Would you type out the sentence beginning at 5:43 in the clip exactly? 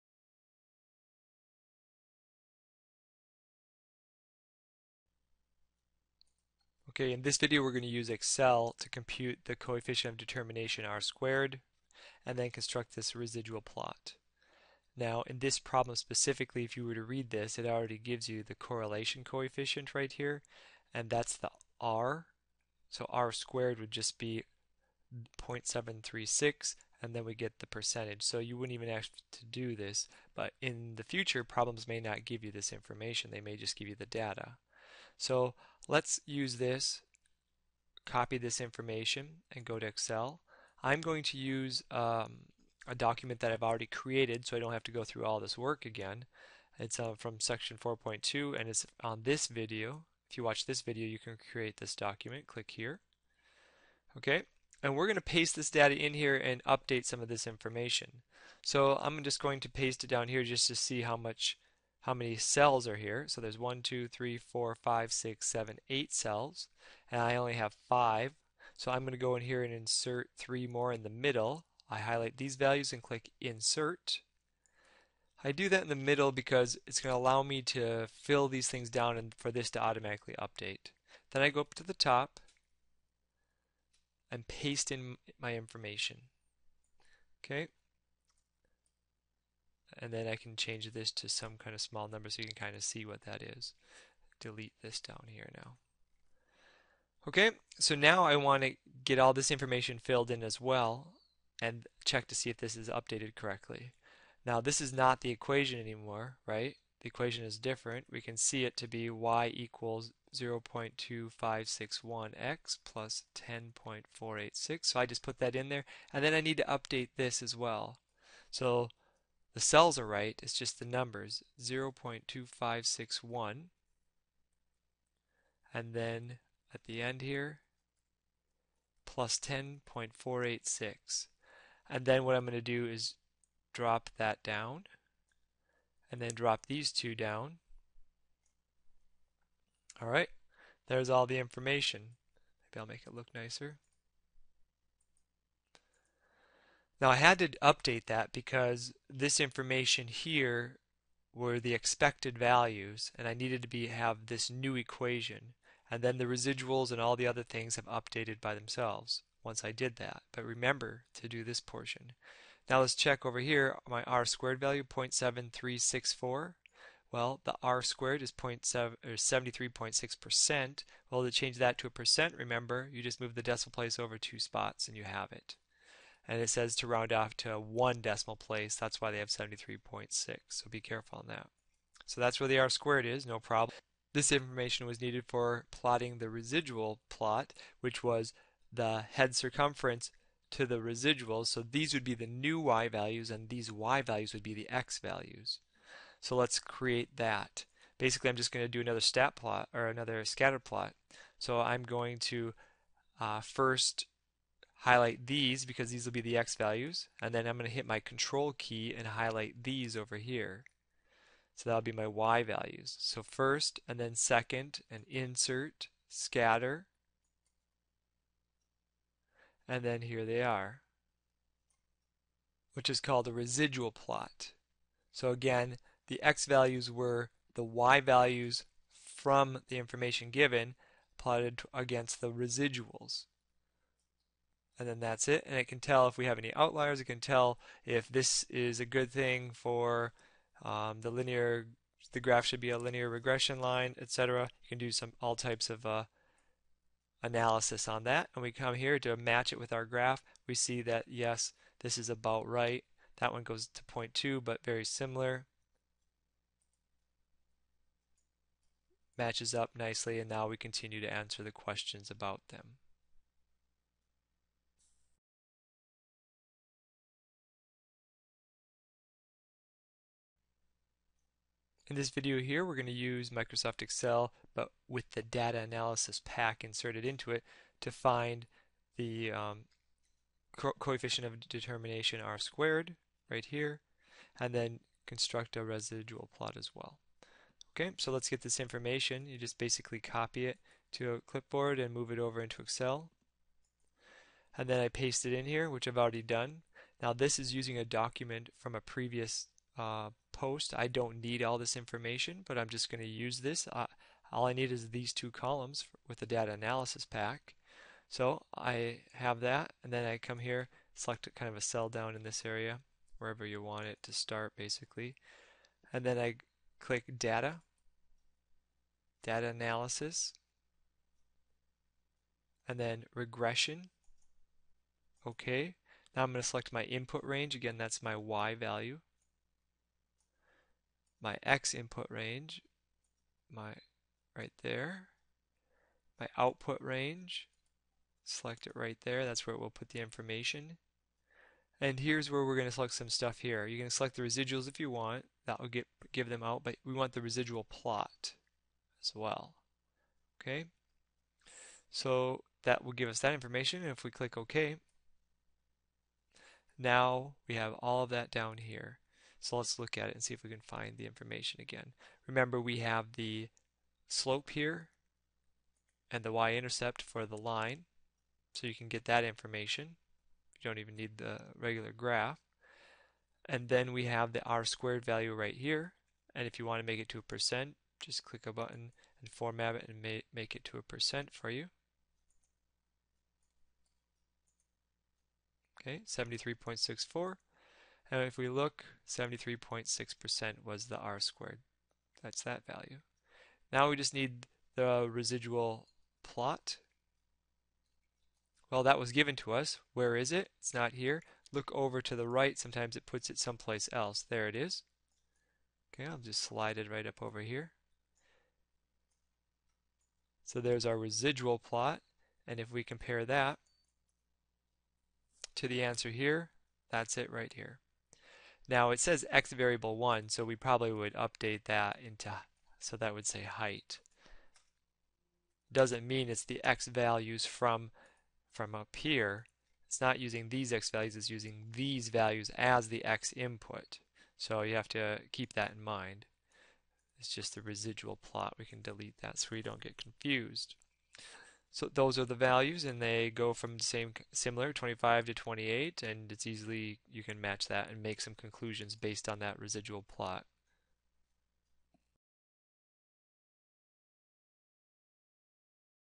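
You can select the residuals if you want, that will get, give them out, but we want the residual plot as well.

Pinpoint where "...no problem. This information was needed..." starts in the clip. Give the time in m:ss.
3:03.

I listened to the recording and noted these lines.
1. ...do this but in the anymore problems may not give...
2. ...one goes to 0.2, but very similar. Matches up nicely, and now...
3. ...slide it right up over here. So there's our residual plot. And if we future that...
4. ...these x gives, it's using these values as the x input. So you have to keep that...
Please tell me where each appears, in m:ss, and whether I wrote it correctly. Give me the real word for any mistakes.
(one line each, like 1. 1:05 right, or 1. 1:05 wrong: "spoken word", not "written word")
1. 0:29 wrong: "future", not "anymore"
2. 4:13 right
3. 6:46 wrong: "compare", not "future"
4. 7:10 wrong: "values", not "gives".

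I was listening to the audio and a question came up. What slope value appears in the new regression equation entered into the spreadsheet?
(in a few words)
0.2561.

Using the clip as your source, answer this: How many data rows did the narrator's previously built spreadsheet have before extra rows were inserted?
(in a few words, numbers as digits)
5.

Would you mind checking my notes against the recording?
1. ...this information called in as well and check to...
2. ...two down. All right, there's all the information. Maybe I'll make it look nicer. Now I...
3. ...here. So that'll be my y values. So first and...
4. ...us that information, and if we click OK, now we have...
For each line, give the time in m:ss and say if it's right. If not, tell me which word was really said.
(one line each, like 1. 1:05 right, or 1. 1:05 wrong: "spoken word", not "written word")
1. 1:39 wrong: "filled", not "called"
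2. 2:16 right
3. 3:30 right
4. 5:53 right.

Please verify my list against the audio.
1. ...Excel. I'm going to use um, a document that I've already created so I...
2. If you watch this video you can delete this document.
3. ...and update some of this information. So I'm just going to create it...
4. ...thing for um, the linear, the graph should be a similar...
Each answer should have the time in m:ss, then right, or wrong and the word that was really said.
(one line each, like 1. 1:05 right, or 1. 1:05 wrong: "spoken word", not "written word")
1. 0:39 right
2. 0:50 wrong: "create", not "delete"
3. 0:56 wrong: "paste", not "create"
4. 3:59 wrong: "linear", not "similar".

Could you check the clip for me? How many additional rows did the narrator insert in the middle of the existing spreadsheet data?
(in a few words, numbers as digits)
3.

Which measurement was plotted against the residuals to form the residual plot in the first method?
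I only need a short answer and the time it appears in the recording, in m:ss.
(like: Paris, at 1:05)
head circumference, at 3:09.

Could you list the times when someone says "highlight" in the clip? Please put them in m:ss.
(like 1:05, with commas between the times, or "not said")
1:11, 3:24, 3:29.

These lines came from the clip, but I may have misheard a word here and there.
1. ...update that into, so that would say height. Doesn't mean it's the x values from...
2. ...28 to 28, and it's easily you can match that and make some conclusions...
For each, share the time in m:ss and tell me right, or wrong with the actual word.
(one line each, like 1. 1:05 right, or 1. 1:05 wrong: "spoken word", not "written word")
1. 7:01 right
2. 7:24 wrong: "25", not "28".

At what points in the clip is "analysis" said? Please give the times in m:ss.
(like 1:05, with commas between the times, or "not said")
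4:07, 4:35, 5:06, 5:19.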